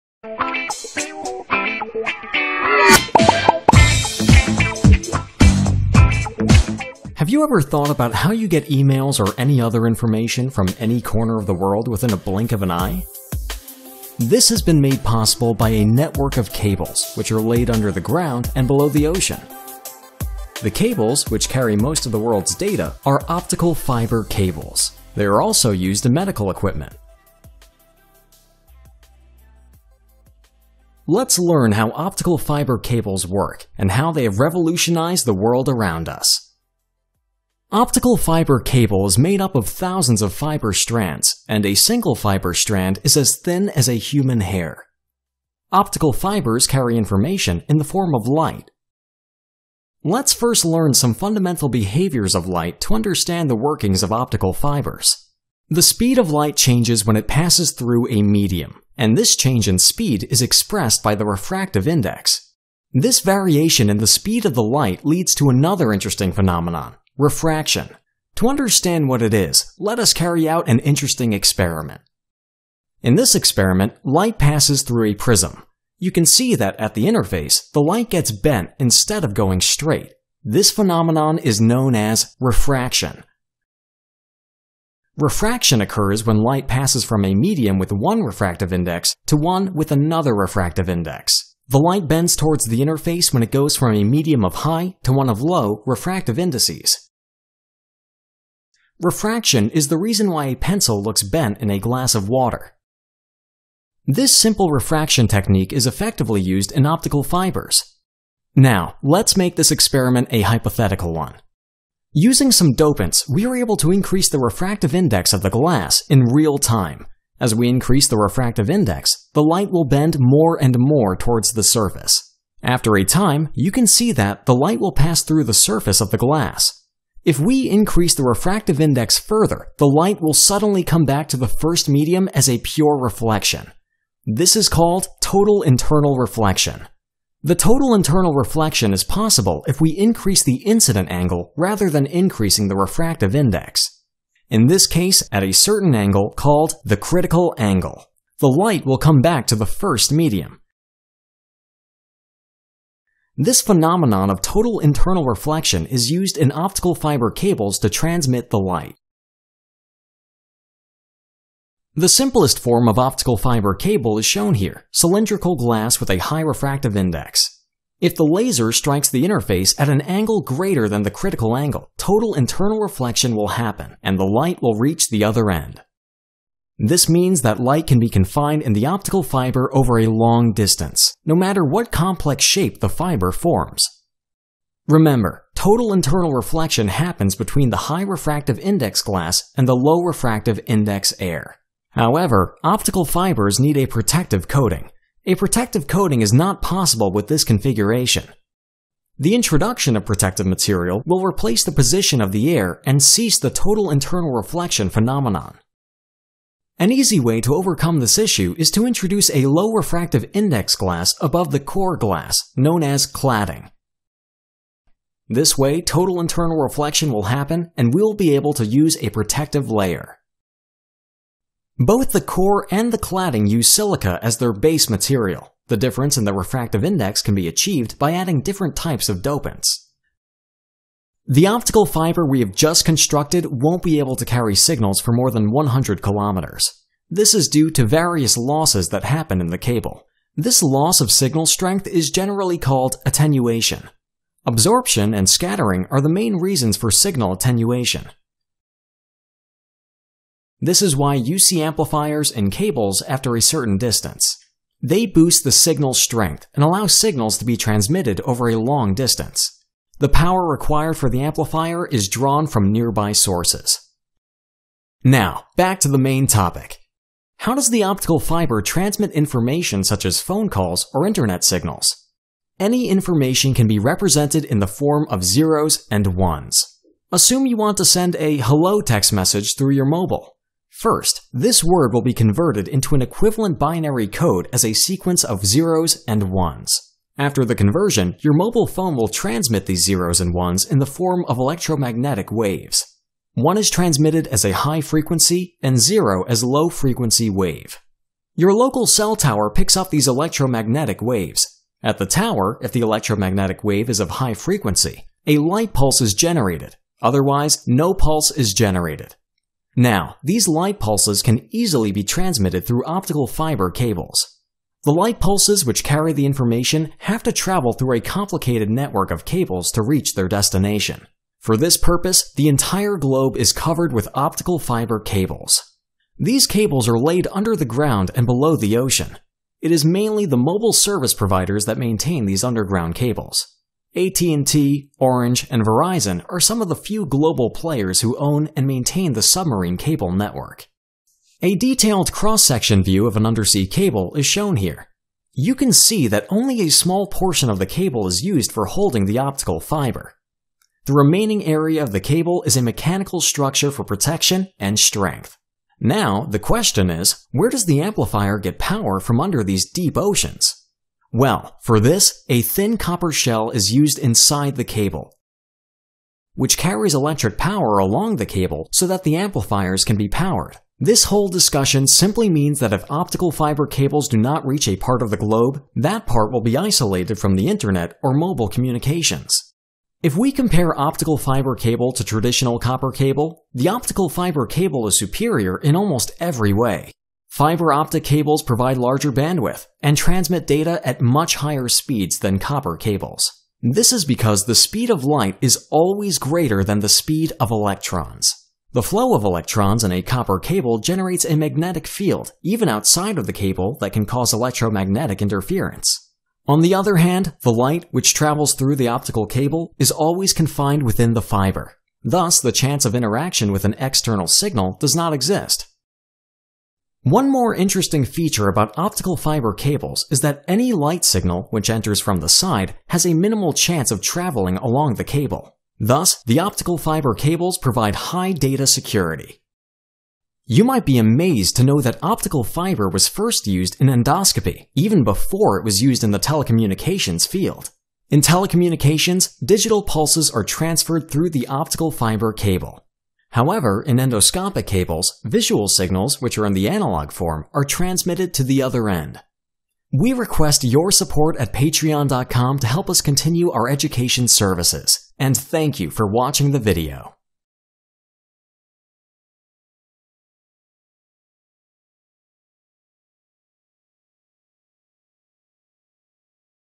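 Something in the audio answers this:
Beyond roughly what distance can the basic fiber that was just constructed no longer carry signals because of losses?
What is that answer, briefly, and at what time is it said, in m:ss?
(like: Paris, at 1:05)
100 kilometers, at 3:55.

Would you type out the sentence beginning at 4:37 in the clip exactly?
Assume you want to send a hello text message through your mobile.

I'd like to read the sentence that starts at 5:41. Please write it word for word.
A detailed cross-section view of an undersea cable is shown here.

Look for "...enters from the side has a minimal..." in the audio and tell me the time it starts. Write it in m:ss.
7:01.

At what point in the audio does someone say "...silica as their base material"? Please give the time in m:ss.
3:43.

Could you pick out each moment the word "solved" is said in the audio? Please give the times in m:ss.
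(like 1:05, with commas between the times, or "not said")
not said.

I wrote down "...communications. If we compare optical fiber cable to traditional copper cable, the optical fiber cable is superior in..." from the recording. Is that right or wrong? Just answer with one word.
right.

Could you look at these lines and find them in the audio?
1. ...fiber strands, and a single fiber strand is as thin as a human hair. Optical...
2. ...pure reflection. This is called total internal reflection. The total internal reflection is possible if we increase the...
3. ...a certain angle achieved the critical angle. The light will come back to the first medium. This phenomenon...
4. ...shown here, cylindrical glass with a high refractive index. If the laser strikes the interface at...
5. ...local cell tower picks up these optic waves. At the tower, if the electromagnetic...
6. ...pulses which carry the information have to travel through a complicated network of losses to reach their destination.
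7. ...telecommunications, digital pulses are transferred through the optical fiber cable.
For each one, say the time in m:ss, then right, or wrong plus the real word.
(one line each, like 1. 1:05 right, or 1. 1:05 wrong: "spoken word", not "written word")
1. 0:40 right
2. 2:12 right
3. 2:25 wrong: "called", not "achieved"
4. 2:44 right
5. 4:58 wrong: "electromagnetic", not "optic"
6. 5:15 wrong: "cables", not "losses"
7. 7:18 right.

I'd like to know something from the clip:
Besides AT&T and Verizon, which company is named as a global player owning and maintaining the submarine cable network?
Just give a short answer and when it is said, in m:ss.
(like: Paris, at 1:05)
Orange, at 5:34.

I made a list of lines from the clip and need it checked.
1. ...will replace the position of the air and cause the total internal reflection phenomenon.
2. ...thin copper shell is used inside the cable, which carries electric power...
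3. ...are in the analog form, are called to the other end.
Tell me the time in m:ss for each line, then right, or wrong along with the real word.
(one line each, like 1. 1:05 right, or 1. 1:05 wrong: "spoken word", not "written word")
1. 3:21 wrong: "cease", not "cause"
2. 6:02 right
3. 7:26 wrong: "transmitted", not "called".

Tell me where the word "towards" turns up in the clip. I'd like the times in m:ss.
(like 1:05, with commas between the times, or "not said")
1:32, 2:01.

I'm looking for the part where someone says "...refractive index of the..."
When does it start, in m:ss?
1:54.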